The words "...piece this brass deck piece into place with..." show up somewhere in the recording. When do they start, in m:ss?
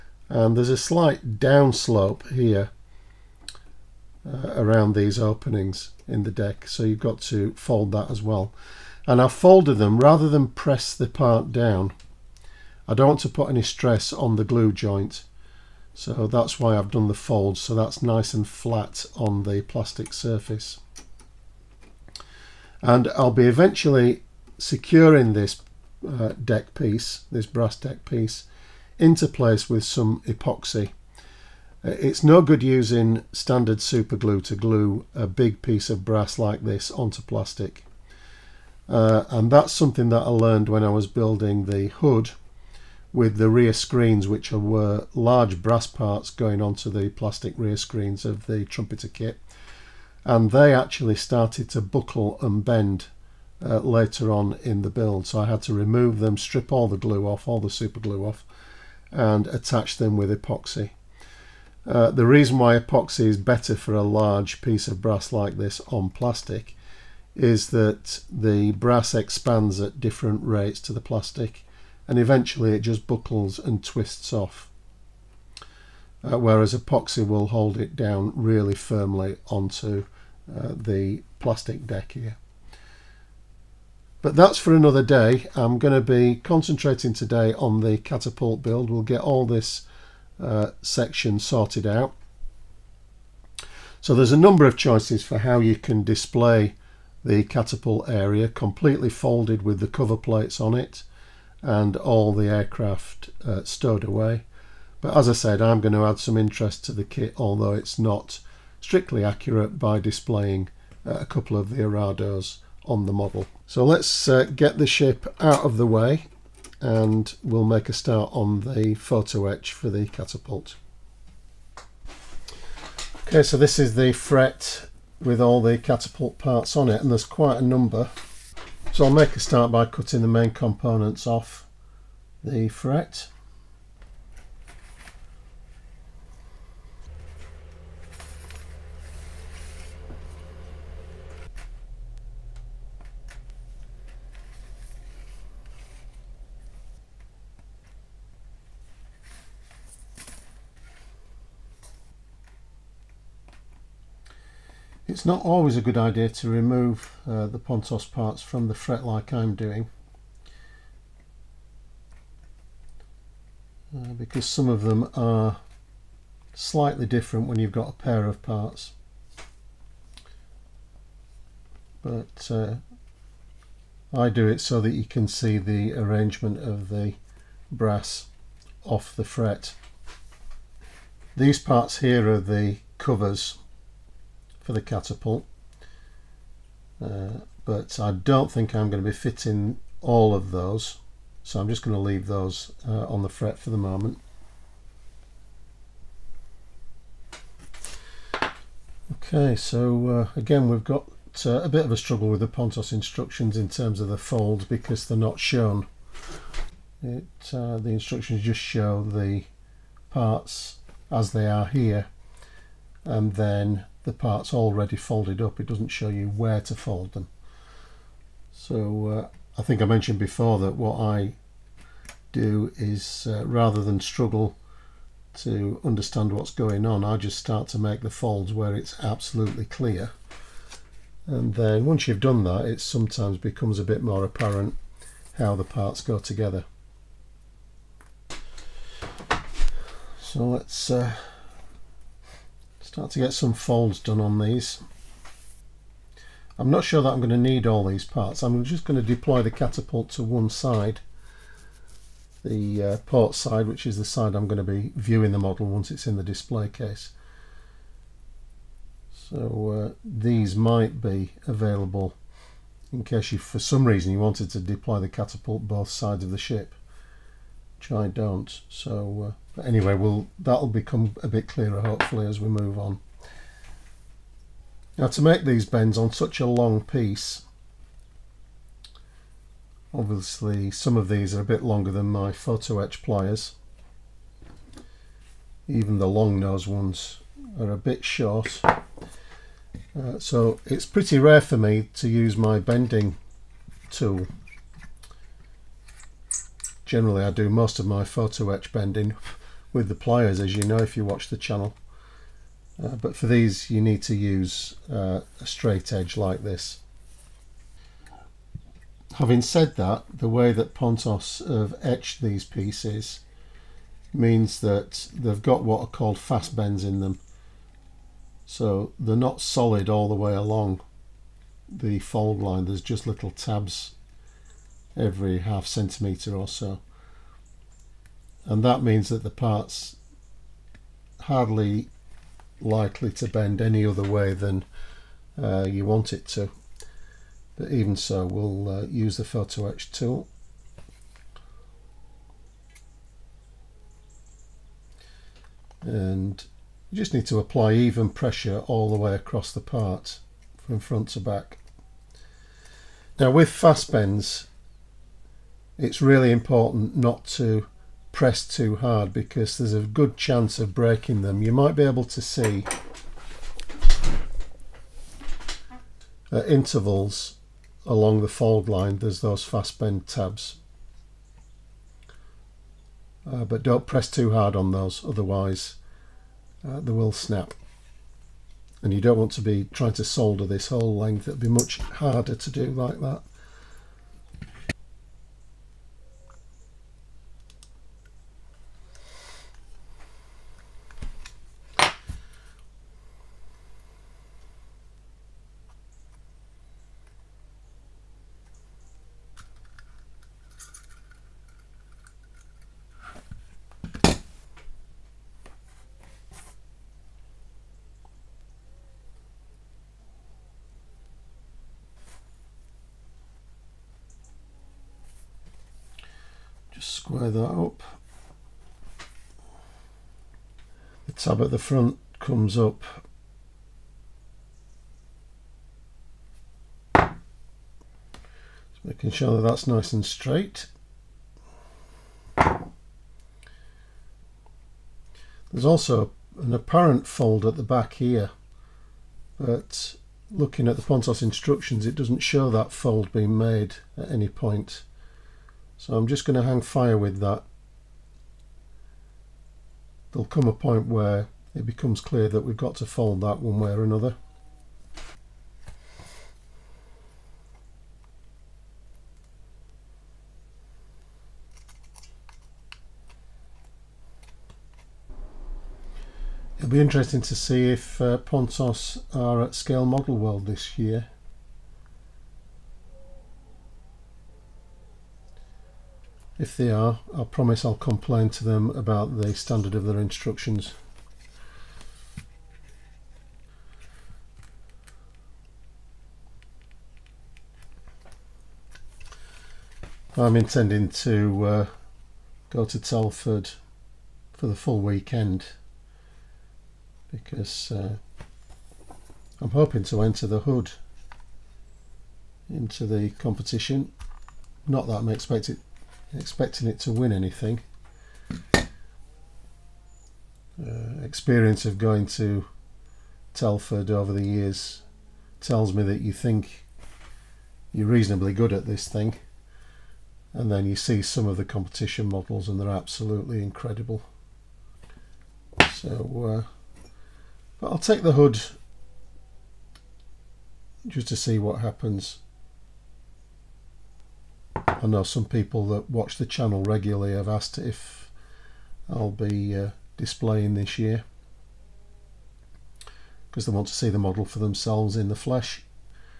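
0:26.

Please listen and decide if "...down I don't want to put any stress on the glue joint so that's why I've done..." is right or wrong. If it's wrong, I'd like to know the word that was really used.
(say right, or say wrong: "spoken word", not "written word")
right.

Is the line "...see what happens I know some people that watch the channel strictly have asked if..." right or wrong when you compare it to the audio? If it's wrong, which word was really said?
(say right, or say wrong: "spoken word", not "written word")
wrong: "regularly", not "strictly".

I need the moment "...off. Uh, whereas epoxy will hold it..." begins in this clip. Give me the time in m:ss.
1:14.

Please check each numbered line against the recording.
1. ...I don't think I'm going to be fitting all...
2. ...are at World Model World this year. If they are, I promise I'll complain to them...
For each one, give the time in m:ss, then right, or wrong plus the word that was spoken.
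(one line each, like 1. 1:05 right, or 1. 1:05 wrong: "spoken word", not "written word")
1. 3:08 right
2. 7:49 wrong: "Scale", not "World".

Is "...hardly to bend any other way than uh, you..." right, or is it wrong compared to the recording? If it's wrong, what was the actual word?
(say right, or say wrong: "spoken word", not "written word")
wrong: "likely", not "hardly".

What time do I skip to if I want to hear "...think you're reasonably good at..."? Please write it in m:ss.
8:36.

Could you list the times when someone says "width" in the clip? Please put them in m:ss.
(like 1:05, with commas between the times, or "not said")
not said.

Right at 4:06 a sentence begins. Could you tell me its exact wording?
I'm not sure that I'm going to need all these parts.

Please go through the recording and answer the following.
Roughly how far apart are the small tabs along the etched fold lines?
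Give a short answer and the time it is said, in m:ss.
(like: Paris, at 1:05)
Half centimetre, at 5:25.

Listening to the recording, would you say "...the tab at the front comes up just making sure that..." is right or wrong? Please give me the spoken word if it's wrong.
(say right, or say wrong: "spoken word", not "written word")
right.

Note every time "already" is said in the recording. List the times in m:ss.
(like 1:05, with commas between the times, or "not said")
3:34.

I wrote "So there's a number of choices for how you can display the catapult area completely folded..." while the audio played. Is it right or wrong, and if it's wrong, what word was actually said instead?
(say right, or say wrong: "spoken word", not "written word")
right.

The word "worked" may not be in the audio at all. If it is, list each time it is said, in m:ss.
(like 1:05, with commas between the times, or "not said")
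not said.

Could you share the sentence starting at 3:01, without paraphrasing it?
These parts here are the covers for the catapult.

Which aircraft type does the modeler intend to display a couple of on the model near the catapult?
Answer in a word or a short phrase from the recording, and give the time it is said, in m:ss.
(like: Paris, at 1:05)
Arados, at 1:51.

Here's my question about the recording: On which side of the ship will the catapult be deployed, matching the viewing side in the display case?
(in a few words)
Port side.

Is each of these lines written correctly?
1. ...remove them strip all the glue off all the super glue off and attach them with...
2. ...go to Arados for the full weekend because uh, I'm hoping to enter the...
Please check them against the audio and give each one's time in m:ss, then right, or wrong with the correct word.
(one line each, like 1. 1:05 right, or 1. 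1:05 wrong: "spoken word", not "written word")
1. 0:55 right
2. 8:12 wrong: "Telford", not "Arados".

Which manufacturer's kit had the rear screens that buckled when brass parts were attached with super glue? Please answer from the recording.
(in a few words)
Trumpeter.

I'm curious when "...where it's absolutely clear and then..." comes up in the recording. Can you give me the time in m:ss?
3:48.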